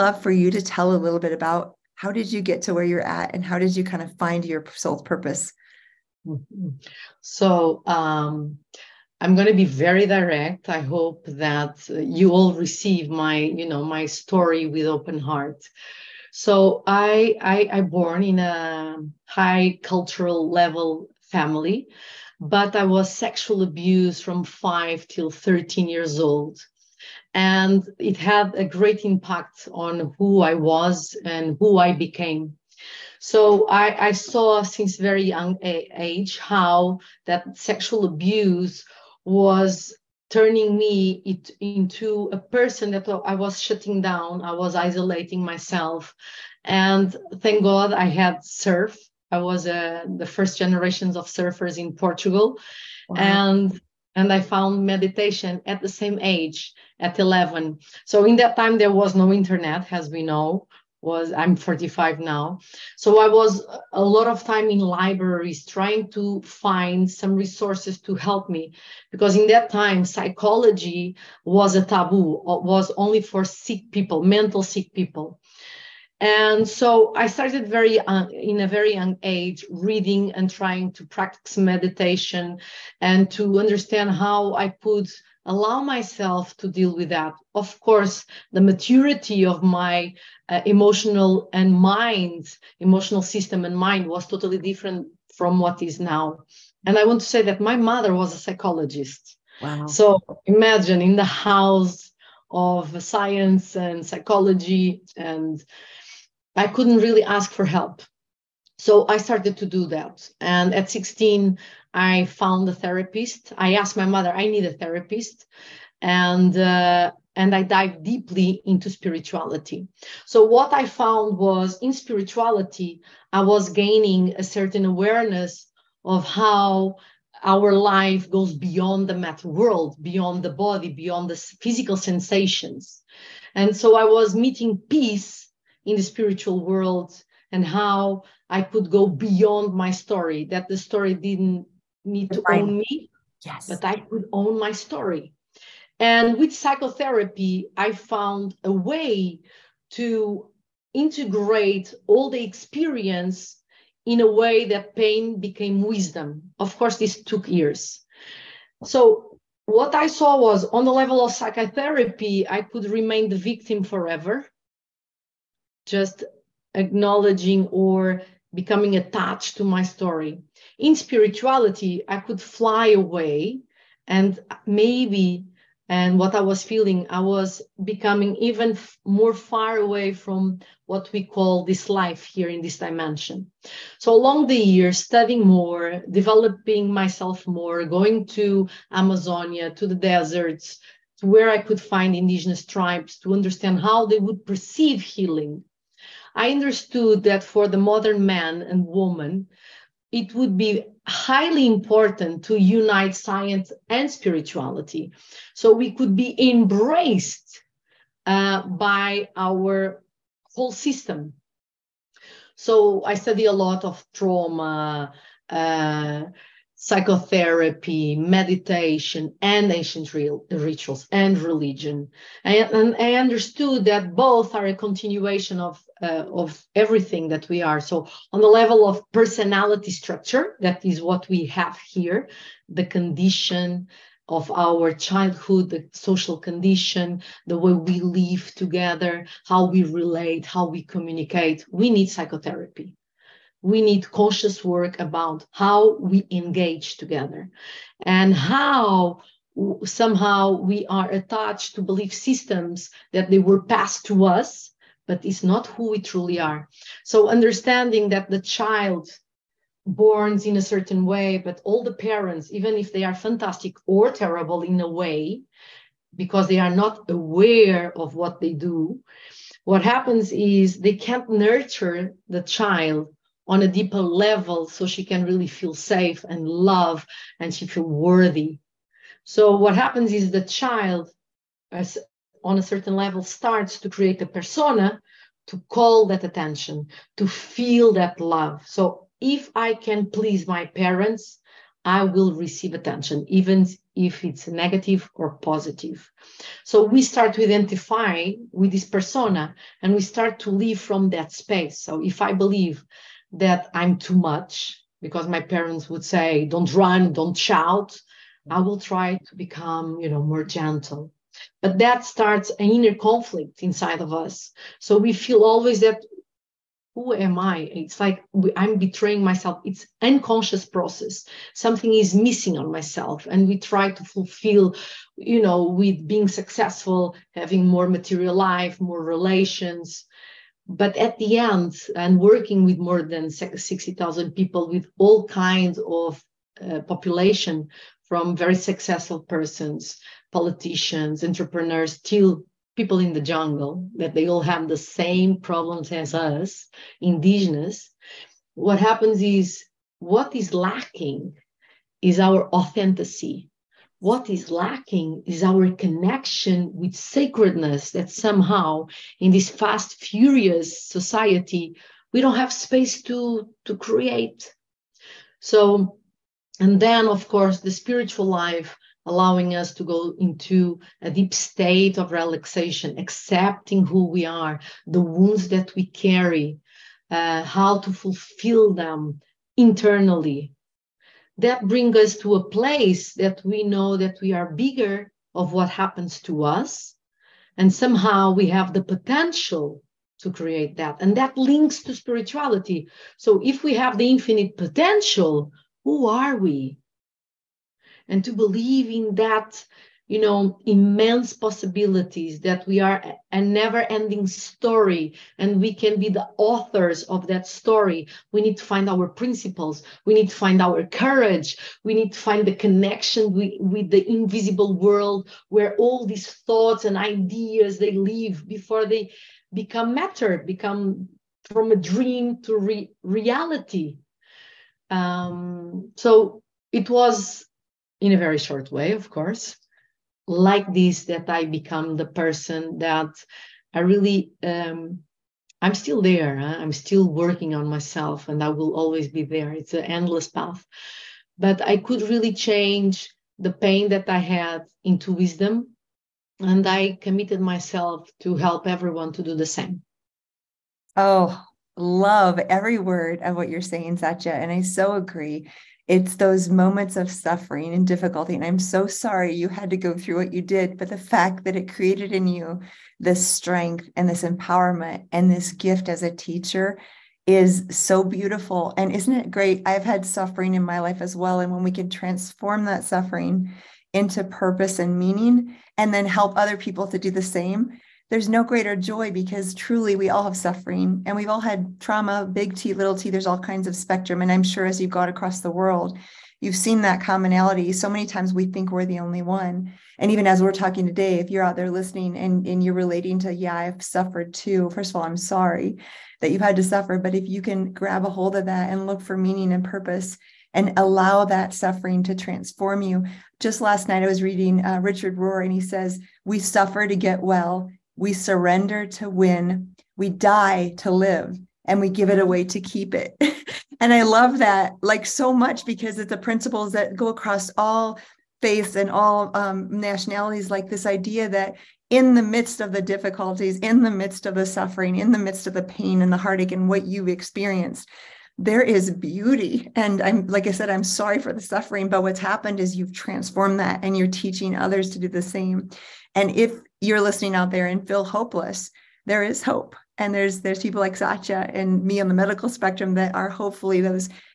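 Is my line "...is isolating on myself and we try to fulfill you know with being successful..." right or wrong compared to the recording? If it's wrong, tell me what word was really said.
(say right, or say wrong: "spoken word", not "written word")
wrong: "missing", not "isolating".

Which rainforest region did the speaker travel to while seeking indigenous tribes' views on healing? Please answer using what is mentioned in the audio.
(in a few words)
Amazonia.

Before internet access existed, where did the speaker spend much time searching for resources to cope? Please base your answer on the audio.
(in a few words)
libraries.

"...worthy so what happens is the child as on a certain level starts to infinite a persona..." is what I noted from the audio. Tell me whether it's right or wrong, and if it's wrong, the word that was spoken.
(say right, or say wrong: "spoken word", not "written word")
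wrong: "create", not "infinite".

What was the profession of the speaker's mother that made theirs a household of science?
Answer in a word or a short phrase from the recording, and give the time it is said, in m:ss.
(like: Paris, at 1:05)
psychologist, at 1:38.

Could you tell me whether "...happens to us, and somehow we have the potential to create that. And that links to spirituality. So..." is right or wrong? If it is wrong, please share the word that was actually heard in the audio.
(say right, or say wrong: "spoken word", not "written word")
right.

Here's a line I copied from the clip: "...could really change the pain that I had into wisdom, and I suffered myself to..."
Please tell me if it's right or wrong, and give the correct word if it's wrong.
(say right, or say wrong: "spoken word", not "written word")
wrong: "committed", not "suffered".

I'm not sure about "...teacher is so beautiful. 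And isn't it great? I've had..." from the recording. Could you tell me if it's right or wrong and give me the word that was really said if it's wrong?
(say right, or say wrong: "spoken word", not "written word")
right.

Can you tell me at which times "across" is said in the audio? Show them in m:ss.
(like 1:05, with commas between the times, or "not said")
8:05, 8:37.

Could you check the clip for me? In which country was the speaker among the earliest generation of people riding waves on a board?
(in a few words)
Portugal.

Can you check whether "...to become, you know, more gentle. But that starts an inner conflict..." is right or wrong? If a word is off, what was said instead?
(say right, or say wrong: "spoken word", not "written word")
right.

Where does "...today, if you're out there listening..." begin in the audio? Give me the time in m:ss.
8:10.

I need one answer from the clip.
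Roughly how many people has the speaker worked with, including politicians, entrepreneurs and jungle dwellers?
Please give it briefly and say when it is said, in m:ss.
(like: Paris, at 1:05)
more than 60000, at 5:32.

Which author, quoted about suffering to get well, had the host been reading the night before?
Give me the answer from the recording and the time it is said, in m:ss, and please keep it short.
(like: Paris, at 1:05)
Richard Rohr, at 8:24.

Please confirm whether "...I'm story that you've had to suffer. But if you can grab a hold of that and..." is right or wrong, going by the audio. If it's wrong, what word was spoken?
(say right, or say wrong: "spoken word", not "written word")
wrong: "sorry", not "story".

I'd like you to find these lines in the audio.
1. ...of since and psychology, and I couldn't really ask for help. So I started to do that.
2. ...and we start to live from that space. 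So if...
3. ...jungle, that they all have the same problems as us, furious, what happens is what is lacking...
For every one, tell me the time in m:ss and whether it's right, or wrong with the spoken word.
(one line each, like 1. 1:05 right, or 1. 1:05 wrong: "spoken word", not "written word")
1. 1:42 wrong: "science", not "since"
2. 4:59 right
3. 5:43 wrong: "indigenous", not "furious".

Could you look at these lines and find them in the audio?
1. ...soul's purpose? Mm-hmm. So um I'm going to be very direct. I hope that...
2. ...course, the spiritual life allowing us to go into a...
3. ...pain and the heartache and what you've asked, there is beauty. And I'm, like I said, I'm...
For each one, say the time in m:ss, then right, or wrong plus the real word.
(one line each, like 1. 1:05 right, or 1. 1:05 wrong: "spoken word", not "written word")
1. 0:04 right
2. 6:07 right
3. 8:45 wrong: "experienced", not "asked".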